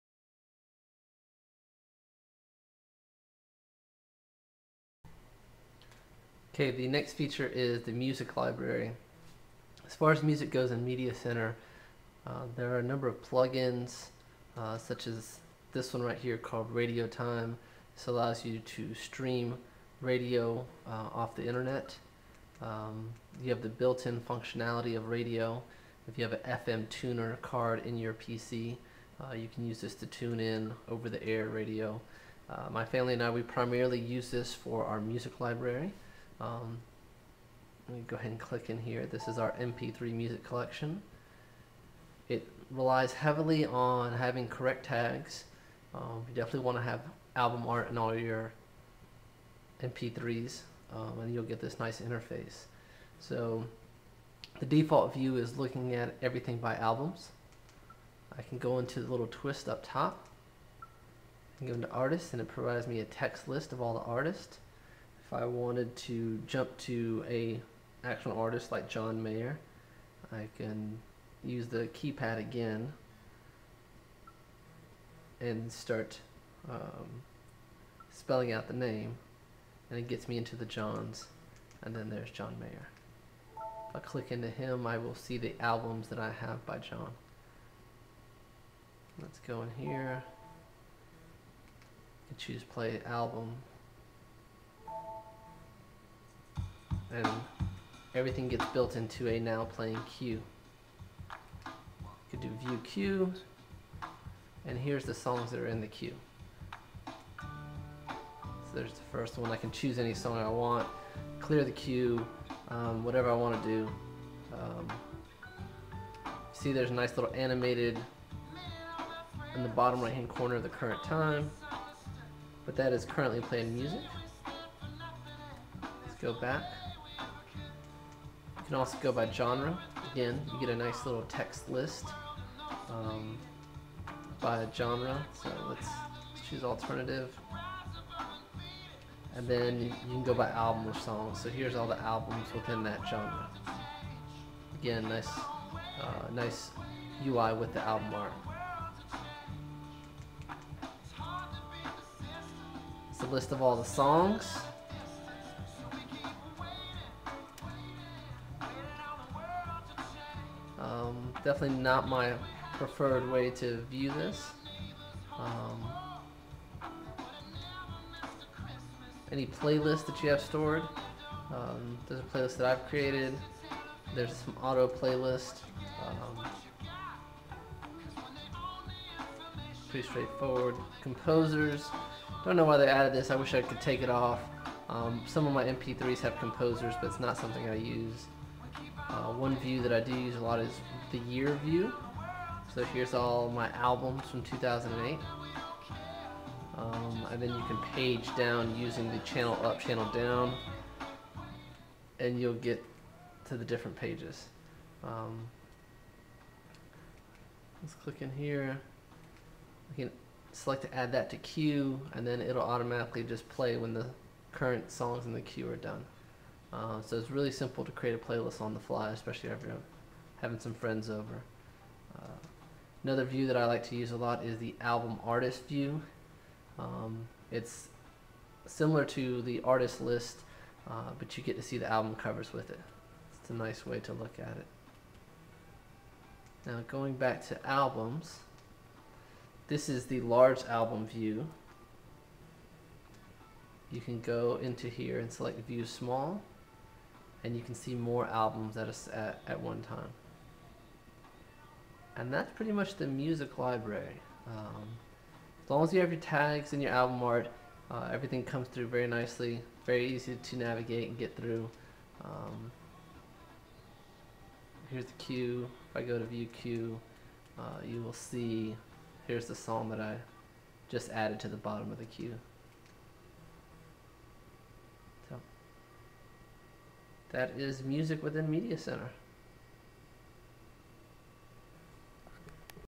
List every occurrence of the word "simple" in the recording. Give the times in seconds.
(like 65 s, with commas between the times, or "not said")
217 s.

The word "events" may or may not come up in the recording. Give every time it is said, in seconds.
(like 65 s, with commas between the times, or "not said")
not said.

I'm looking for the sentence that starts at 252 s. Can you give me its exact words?
And that's pretty much the music library.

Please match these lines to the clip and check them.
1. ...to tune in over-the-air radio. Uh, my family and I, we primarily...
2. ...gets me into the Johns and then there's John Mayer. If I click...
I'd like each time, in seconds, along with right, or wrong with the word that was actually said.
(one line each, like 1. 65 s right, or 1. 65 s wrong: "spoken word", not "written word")
1. 29 s right
2. 80 s right.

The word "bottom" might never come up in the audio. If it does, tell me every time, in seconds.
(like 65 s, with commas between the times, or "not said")
119 s, 271 s.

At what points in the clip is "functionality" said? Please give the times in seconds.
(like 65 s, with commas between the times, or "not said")
24 s.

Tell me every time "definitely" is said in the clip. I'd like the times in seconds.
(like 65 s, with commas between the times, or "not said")
46 s, 161 s.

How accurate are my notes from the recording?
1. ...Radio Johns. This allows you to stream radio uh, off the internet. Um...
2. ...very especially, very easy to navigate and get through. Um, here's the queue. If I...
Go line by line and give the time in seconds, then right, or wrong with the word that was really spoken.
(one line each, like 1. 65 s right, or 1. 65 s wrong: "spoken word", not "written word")
1. 16 s wrong: "Time", not "Johns"
2. 258 s wrong: "nicely", not "especially".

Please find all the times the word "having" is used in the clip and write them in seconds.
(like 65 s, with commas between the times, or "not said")
44 s, 220 s.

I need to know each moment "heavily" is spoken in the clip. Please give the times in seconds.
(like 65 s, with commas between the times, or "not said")
43 s.